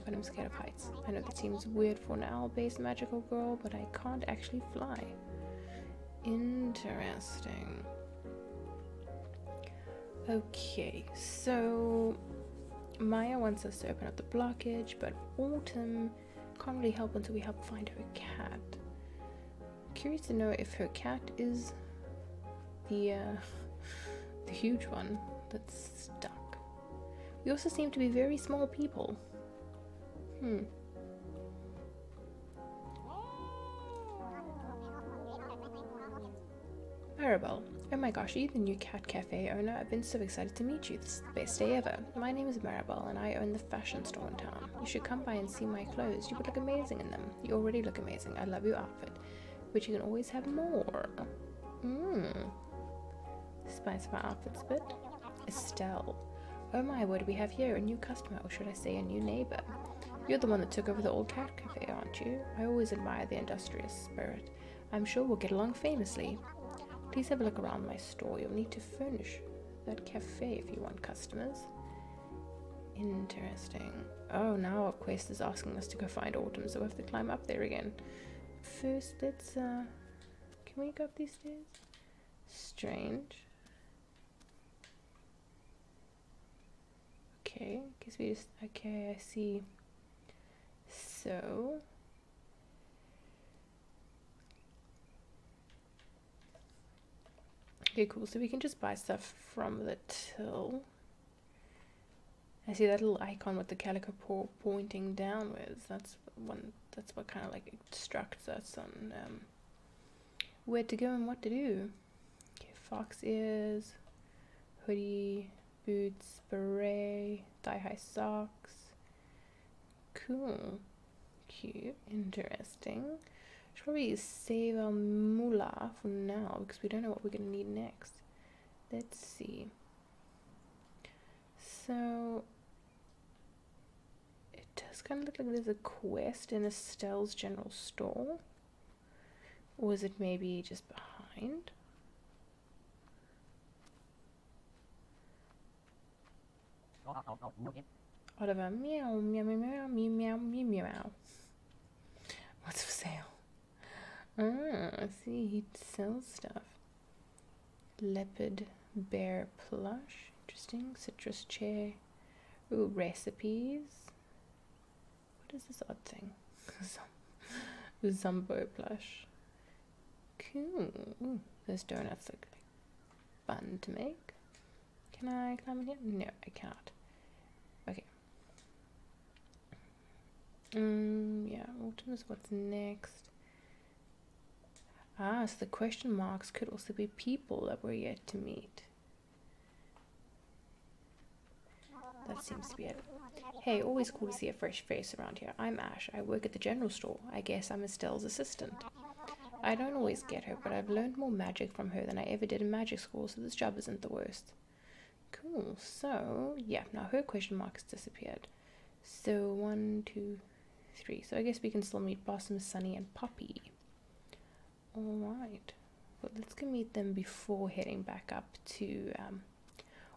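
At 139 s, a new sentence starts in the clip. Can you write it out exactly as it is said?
Or is it maybe just behind?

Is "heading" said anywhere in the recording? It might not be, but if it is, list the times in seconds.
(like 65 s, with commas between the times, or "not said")
217 s.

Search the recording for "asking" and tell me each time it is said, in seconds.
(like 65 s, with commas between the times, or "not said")
75 s.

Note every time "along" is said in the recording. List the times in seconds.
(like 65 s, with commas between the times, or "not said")
65 s.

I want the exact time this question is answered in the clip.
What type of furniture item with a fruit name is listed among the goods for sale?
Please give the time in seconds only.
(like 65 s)
160 s.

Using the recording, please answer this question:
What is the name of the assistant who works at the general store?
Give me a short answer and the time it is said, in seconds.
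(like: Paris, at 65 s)
Ash, at 195 s.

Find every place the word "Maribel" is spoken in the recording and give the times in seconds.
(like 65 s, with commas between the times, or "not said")
37 s, 42 s.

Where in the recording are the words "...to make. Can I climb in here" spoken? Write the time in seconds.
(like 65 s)
173 s.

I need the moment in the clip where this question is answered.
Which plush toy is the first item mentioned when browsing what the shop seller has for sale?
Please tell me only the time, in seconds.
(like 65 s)
158 s.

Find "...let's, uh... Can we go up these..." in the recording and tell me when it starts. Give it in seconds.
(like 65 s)
79 s.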